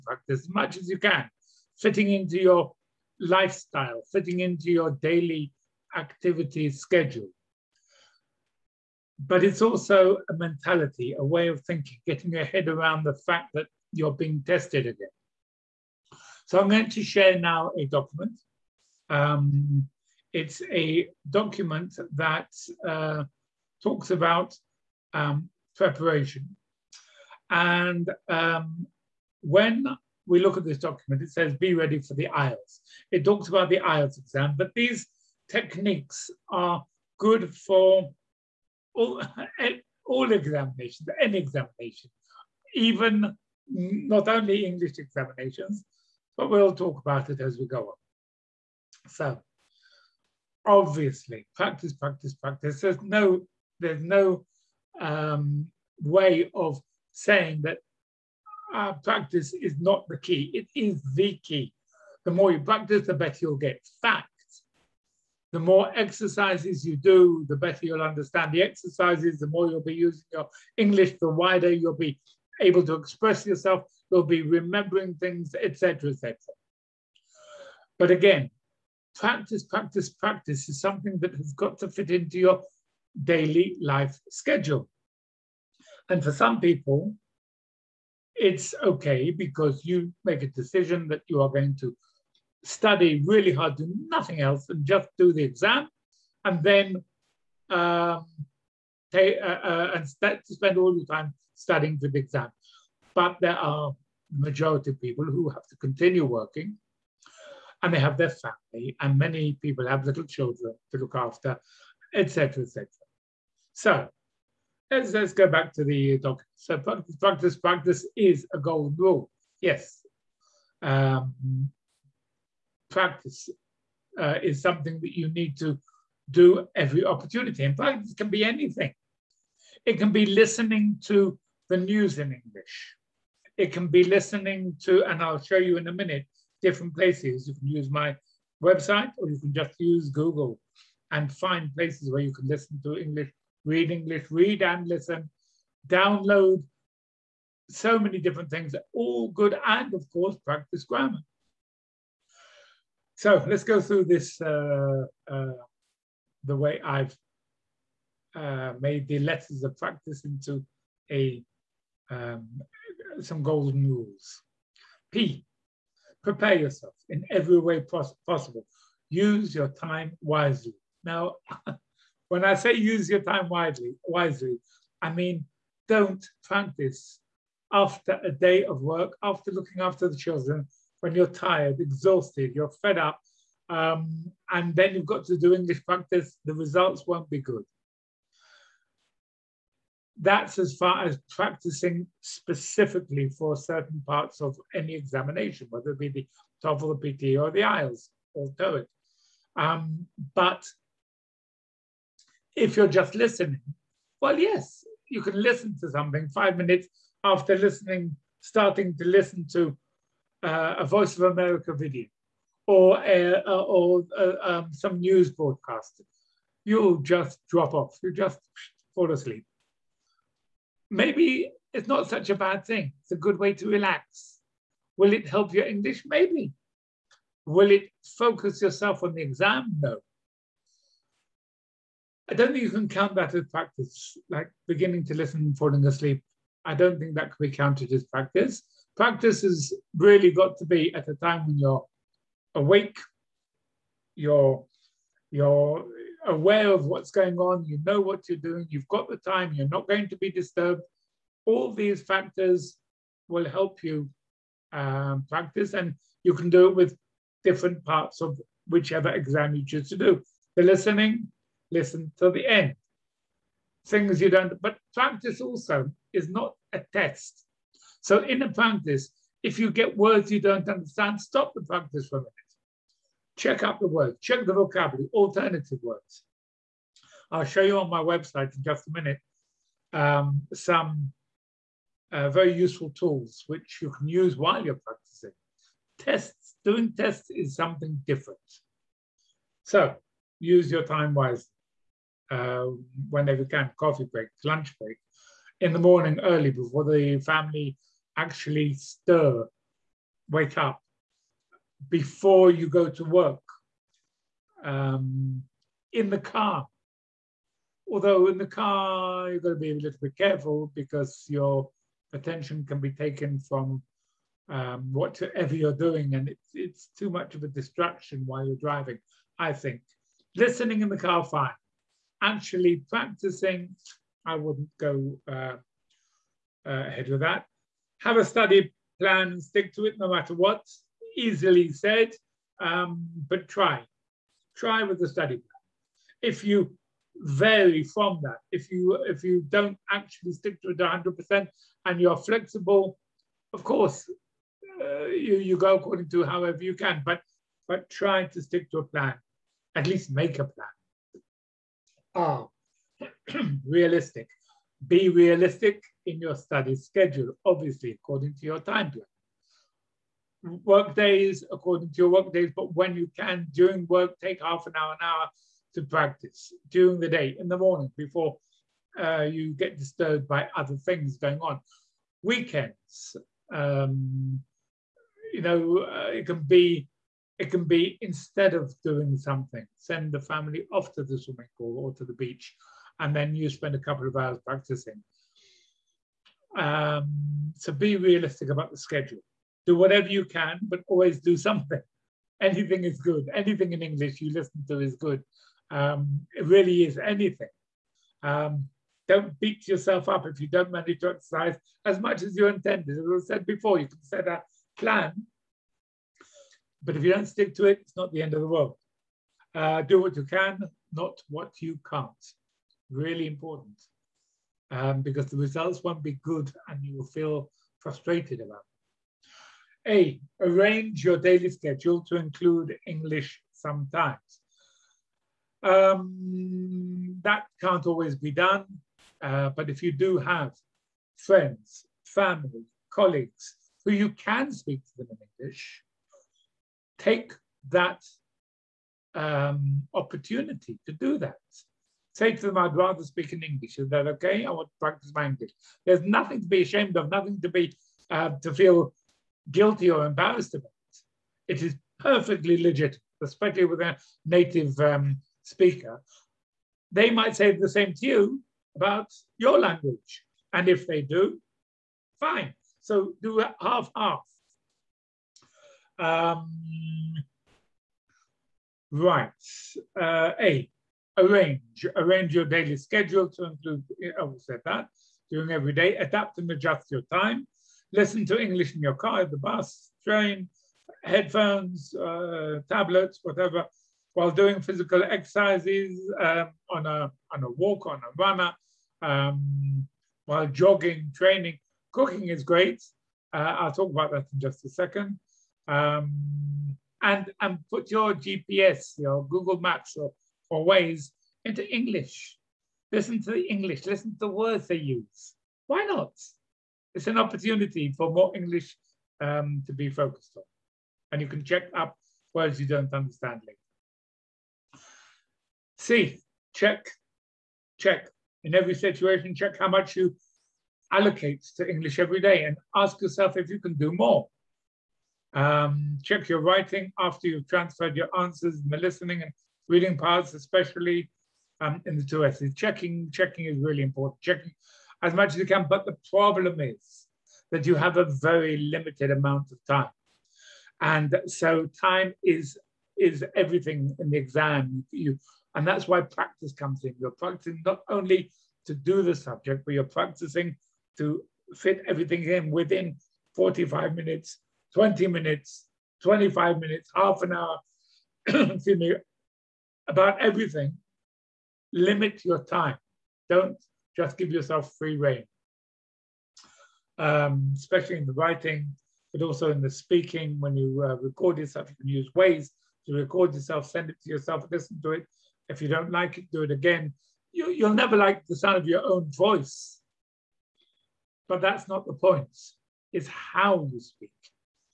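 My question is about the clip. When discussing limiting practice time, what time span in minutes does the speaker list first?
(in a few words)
45 minutes.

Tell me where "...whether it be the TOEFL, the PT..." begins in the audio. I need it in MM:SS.
03:15.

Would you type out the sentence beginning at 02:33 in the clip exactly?
So let's go through this uh, uh, the way I've uh, made the letters of practice into a um, some golden rules.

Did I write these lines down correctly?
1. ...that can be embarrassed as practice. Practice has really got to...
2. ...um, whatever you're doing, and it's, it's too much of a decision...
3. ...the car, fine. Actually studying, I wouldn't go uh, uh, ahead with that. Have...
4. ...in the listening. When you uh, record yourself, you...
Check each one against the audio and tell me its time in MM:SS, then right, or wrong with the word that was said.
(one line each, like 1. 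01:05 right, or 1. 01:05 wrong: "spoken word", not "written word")
1. 03:57 wrong: "counted", not "embarrassed"
2. 05:14 wrong: "distraction", not "decision"
3. 05:20 wrong: "practicing", not "studying"
4. 09:29 wrong: "speaking", not "listening".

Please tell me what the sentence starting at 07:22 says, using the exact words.
Say to them, I'd rather speak in English.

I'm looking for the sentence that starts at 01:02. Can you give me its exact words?
The more you practice, the better you'll get.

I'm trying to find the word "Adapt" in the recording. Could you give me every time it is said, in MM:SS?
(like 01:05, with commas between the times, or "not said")
07:55.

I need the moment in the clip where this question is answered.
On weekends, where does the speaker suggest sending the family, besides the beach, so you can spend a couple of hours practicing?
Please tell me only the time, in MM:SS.
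06:21.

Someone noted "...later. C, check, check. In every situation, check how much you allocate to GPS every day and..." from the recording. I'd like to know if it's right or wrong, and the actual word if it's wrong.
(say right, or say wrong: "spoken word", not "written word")
wrong: "English", not "GPS".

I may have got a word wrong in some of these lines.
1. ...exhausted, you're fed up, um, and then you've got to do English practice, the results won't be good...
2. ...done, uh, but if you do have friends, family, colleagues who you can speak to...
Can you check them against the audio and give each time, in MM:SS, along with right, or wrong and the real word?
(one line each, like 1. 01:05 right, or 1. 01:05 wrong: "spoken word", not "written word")
1. 03:01 right
2. 07:08 right.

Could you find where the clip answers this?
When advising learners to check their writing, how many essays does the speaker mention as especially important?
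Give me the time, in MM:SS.
08:52.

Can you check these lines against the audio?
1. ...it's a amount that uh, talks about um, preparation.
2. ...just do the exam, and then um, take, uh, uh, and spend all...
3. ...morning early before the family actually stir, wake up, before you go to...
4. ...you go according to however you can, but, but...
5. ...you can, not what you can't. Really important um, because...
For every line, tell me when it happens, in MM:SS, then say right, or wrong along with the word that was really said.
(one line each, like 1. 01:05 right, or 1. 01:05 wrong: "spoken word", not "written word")
1. 00:20 wrong: "document", not "amount"
2. 01:34 right
3. 04:55 right
4. 05:45 right
5. 06:50 right.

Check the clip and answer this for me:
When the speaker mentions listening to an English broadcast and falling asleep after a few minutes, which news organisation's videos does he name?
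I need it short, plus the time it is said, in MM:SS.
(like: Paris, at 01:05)
Voice of America, at 03:30.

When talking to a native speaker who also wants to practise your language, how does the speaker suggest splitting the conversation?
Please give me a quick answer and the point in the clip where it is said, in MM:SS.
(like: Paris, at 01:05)
half half, at 07:43.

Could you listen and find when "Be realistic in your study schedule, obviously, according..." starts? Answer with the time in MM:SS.
05:54.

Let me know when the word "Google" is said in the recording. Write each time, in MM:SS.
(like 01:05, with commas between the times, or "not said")
02:20, 08:19.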